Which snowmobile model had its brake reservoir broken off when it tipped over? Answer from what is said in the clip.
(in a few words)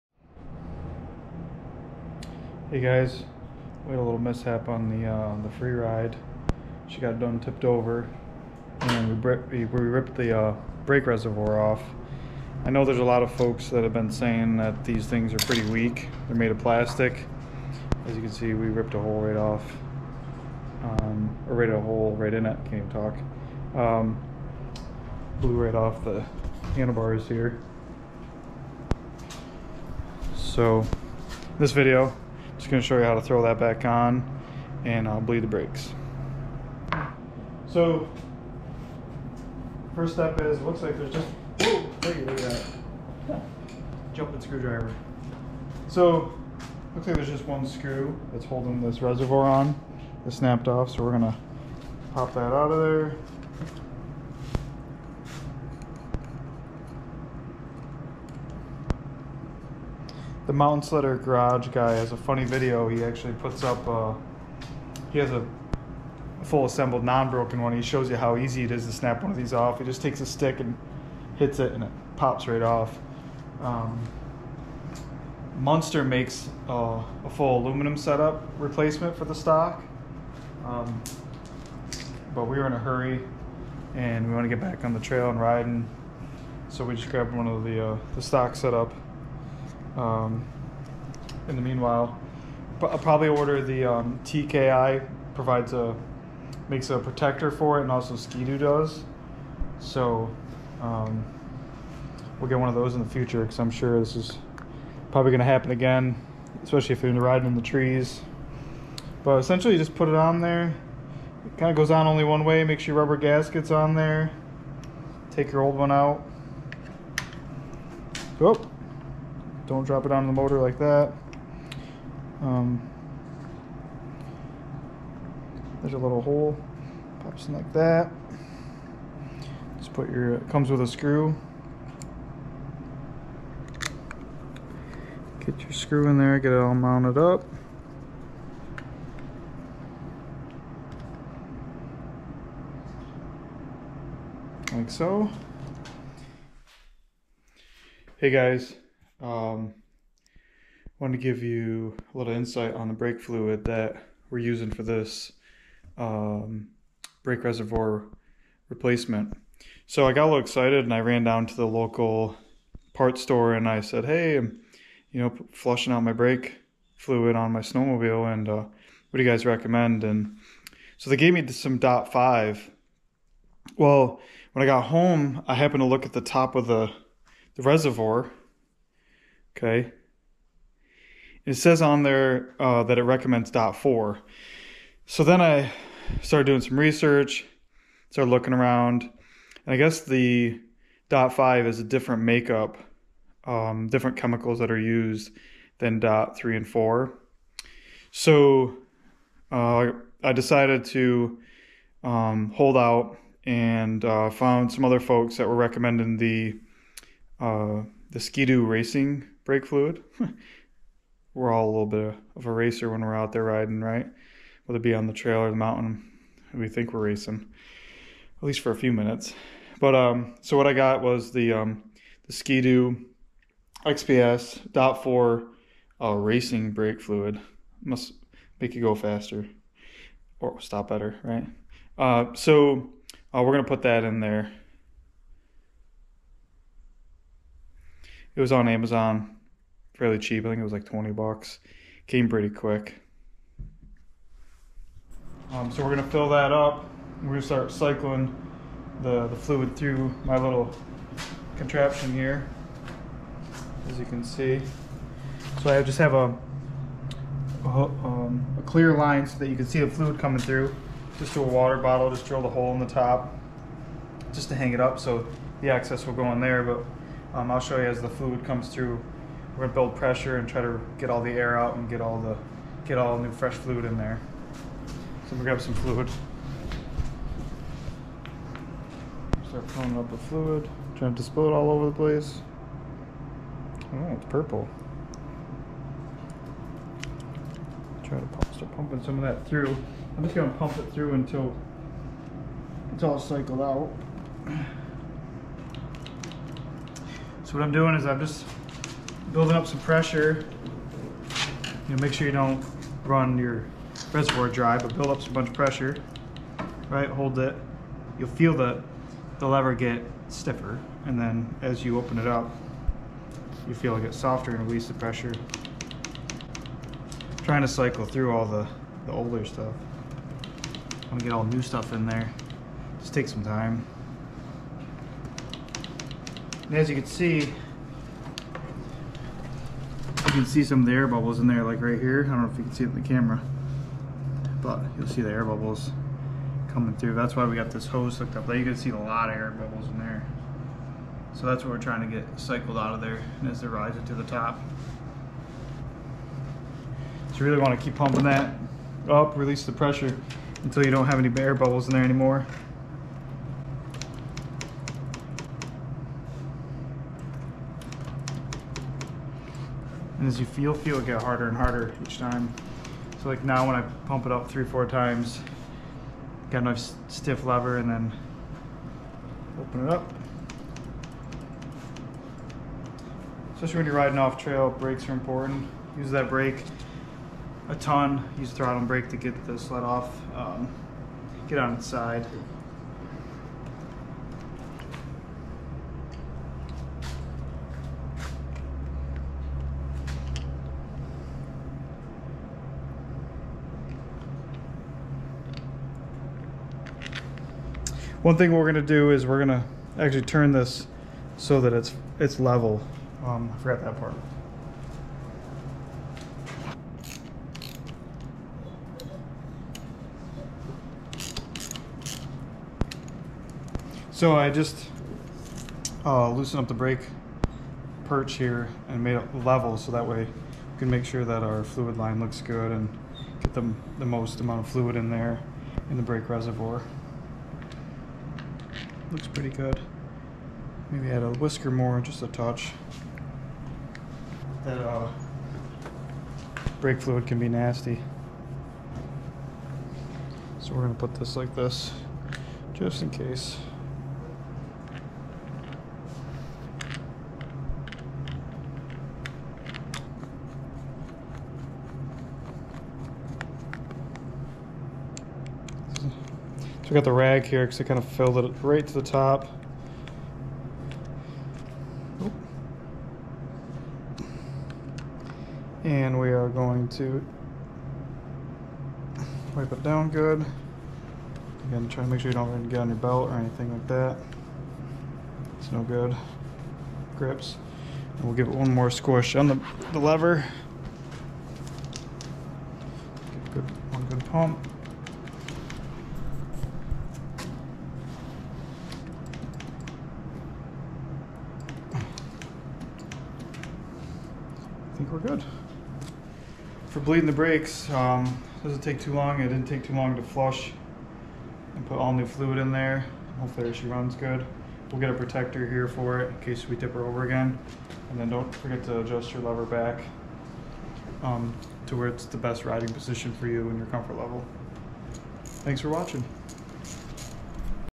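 Freeride.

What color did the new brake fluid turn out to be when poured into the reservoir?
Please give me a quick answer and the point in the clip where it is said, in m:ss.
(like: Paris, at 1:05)
Purple, at 4:44.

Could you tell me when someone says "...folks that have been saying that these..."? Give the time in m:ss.
0:13.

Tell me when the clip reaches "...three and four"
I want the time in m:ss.
3:16.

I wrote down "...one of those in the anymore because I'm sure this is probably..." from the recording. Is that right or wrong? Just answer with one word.
wrong.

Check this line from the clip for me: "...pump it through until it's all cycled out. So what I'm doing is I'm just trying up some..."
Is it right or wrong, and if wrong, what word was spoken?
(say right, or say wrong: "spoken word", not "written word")
wrong: "building", not "trying".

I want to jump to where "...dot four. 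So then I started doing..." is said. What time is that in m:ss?
3:03.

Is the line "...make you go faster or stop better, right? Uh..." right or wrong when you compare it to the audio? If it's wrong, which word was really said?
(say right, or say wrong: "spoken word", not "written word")
right.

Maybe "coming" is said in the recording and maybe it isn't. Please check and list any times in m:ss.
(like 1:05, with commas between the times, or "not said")
4:20, 5:36.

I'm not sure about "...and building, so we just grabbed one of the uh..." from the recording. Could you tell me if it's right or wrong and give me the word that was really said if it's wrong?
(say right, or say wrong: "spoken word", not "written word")
wrong: "riding", not "building".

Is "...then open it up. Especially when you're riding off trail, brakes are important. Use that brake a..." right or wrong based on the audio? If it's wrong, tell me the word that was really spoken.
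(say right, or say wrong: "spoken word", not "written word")
right.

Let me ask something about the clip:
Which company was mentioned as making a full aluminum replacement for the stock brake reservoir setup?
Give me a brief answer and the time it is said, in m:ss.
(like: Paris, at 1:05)
Munster, at 1:15.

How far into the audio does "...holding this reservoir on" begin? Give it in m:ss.
0:48.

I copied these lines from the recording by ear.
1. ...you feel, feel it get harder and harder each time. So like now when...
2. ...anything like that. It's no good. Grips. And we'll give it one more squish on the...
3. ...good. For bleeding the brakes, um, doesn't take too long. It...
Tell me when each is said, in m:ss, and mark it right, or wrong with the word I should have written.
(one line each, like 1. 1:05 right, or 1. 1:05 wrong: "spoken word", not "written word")
1. 6:00 right
2. 7:53 right
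3. 8:15 right.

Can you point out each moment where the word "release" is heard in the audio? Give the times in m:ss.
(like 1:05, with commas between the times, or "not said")
5:14, 5:49.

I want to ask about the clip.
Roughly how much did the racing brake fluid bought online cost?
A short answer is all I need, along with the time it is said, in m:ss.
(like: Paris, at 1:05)
$20, at 4:00.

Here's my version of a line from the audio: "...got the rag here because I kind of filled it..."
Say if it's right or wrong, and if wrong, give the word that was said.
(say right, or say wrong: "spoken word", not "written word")
right.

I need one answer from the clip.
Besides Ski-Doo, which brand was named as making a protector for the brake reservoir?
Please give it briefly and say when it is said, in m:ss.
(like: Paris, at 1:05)
TKI, at 1:34.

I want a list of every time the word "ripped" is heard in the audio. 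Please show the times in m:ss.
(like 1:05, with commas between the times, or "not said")
0:09, 0:18.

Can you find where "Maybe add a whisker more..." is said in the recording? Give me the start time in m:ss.
7:10.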